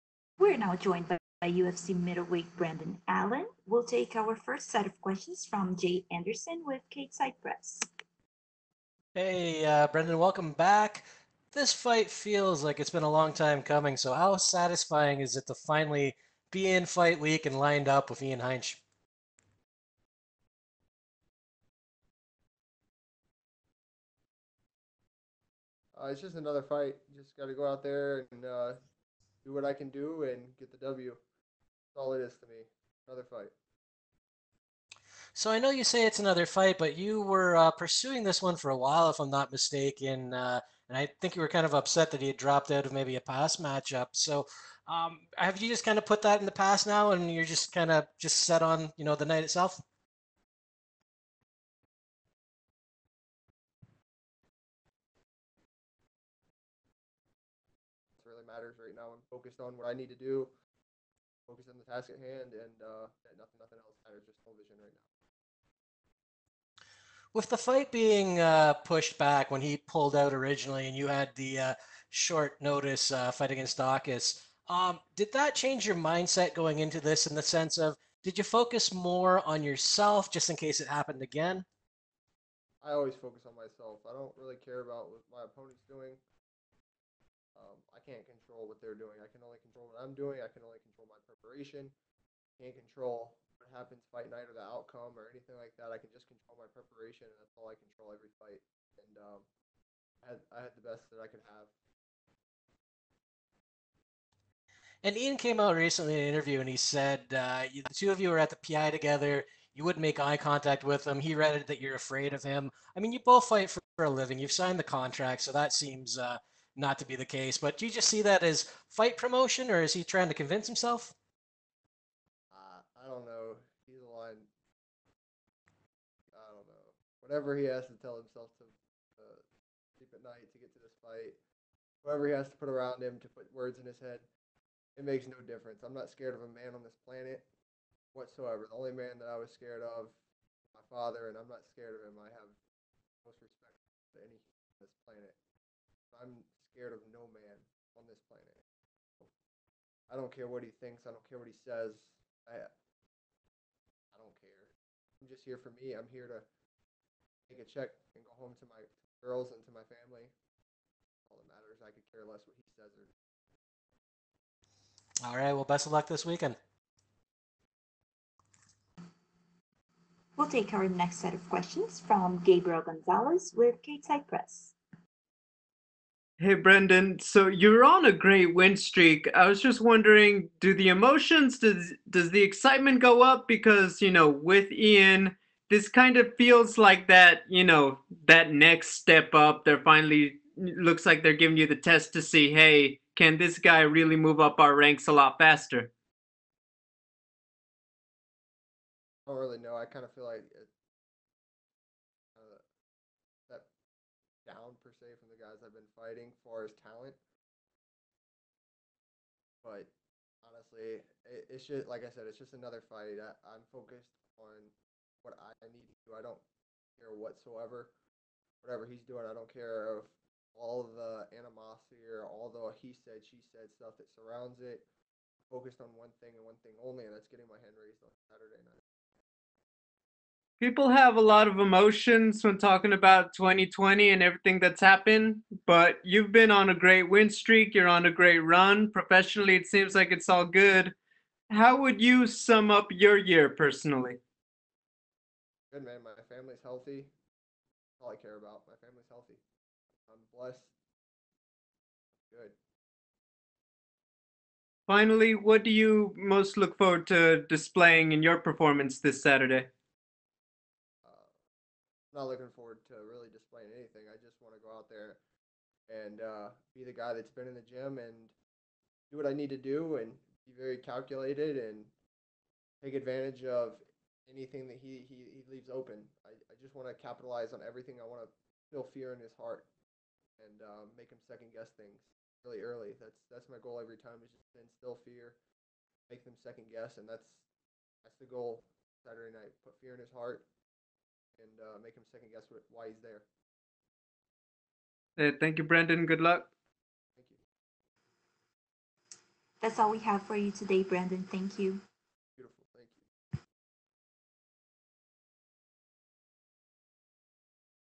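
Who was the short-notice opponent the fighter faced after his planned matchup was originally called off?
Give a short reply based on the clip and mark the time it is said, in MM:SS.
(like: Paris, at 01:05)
Daukaus, at 01:13.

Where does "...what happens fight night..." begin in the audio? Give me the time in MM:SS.
01:33.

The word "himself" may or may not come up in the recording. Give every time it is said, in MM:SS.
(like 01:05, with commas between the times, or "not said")
02:00, 02:08.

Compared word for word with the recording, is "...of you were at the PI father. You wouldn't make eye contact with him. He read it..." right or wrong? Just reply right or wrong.
wrong.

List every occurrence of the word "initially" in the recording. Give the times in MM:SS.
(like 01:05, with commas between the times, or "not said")
not said.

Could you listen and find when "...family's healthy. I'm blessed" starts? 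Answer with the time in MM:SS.
04:08.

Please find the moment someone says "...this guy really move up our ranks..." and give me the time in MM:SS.
03:13.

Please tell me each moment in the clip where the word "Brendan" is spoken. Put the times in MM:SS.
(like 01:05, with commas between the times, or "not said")
00:02, 00:09, 02:56, 04:55, 05:00.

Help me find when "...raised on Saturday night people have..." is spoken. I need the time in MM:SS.
03:47.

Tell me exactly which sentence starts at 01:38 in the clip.
And um, I, had, I had the best that I could have.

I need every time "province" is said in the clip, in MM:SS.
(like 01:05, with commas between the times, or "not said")
not said.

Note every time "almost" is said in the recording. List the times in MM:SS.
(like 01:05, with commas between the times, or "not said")
not said.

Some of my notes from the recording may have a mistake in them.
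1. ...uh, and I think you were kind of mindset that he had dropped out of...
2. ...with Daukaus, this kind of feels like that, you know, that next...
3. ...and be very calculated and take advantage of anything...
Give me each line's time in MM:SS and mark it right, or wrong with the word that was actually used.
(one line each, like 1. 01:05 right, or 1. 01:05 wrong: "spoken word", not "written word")
1. 00:40 wrong: "upset", not "mindset"
2. 03:04 wrong: "Ian", not "Daukaus"
3. 04:29 right.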